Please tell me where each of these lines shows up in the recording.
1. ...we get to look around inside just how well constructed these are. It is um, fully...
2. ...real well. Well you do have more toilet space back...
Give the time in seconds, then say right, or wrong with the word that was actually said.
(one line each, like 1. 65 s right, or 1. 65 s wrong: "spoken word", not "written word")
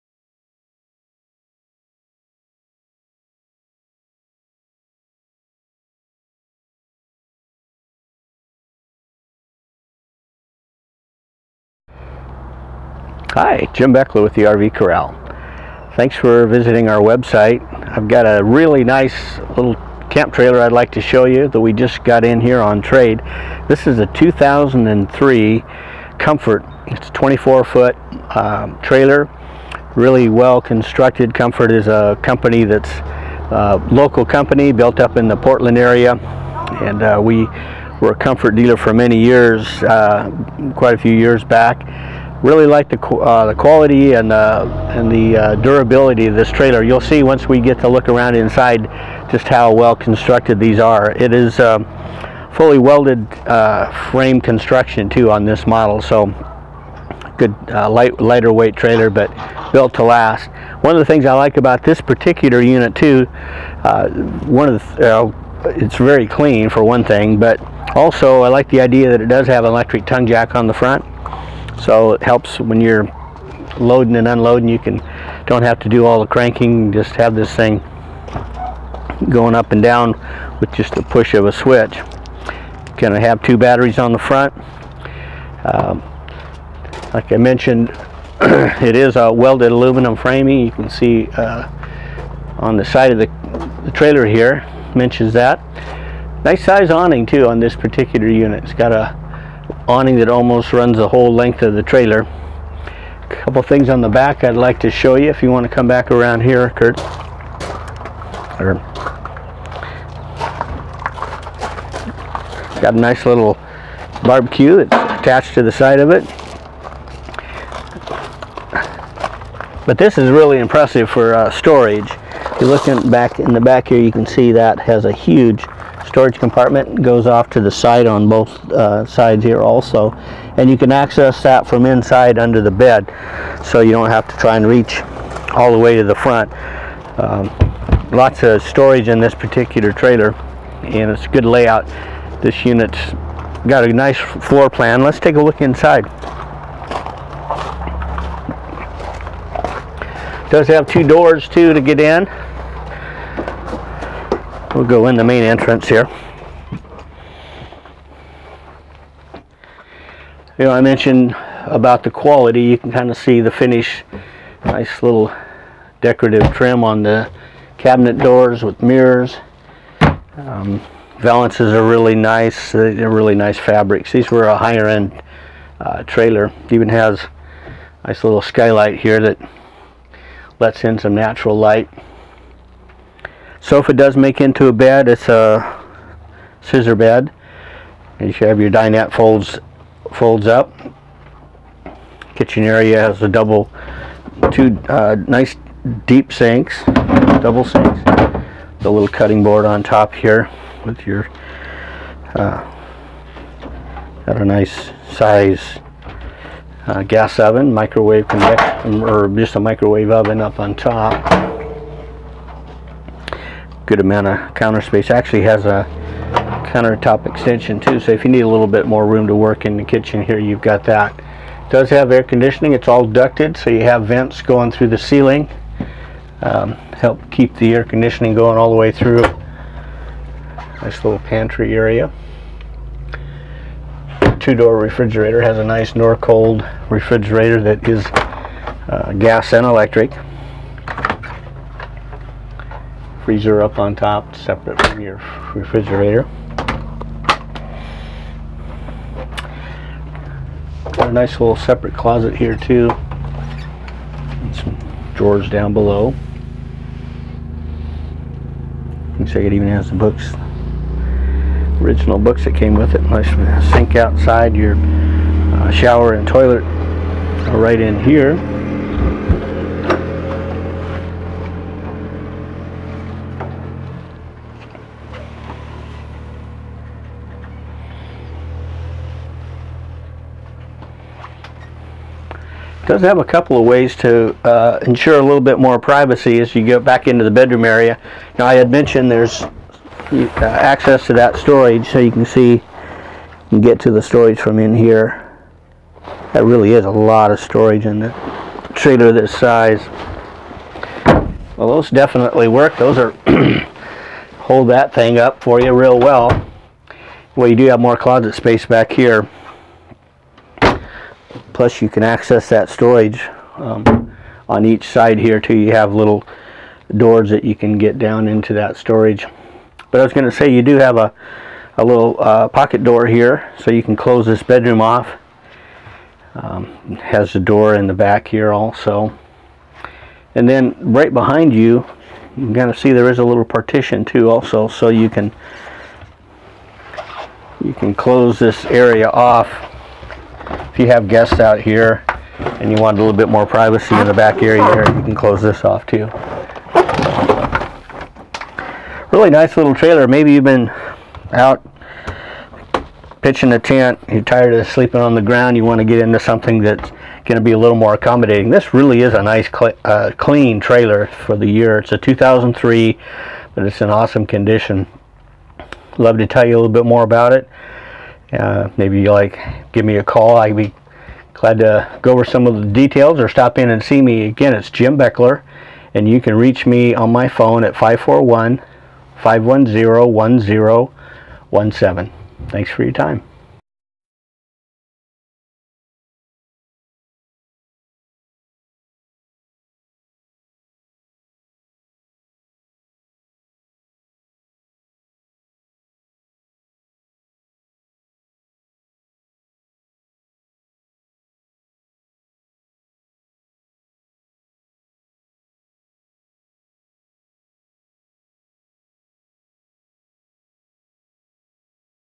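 1. 47 s right
2. 305 s wrong: "closet", not "toilet".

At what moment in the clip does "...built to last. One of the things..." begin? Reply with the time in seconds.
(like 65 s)
59 s.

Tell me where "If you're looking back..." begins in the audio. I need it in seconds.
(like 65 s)
122 s.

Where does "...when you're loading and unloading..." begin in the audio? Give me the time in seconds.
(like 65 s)
72 s.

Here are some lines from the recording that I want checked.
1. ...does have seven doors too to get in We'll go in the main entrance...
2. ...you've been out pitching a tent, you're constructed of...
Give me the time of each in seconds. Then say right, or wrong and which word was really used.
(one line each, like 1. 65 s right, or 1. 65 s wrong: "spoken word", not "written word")
1. 150 s wrong: "two", not "seven"
2. 350 s wrong: "tired", not "constructed".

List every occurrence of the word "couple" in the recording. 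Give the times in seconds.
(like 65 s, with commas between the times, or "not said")
103 s, 283 s.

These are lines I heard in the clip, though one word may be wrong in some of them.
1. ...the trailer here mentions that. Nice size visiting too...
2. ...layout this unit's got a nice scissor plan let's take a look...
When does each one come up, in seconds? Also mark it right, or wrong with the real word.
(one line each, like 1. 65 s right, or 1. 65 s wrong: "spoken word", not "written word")
1. 93 s wrong: "awning", not "visiting"
2. 141 s wrong: "floor", not "scissor".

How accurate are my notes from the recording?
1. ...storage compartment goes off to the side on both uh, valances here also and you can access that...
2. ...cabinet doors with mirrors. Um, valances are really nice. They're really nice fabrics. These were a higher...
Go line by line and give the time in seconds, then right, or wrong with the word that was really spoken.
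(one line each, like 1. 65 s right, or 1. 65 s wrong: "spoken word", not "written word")
1. 126 s wrong: "sides", not "valances"
2. 167 s right.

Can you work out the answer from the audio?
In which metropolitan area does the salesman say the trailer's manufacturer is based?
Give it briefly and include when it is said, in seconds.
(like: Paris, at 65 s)
Portland, at 35 s.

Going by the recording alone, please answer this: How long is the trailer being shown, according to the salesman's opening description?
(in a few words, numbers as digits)
24 feet.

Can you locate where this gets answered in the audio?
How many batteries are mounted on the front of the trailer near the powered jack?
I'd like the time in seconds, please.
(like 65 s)
83 s.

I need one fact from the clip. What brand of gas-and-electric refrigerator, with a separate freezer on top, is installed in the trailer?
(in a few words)
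Norcold.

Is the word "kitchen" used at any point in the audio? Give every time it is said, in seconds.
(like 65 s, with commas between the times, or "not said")
192 s, 219 s.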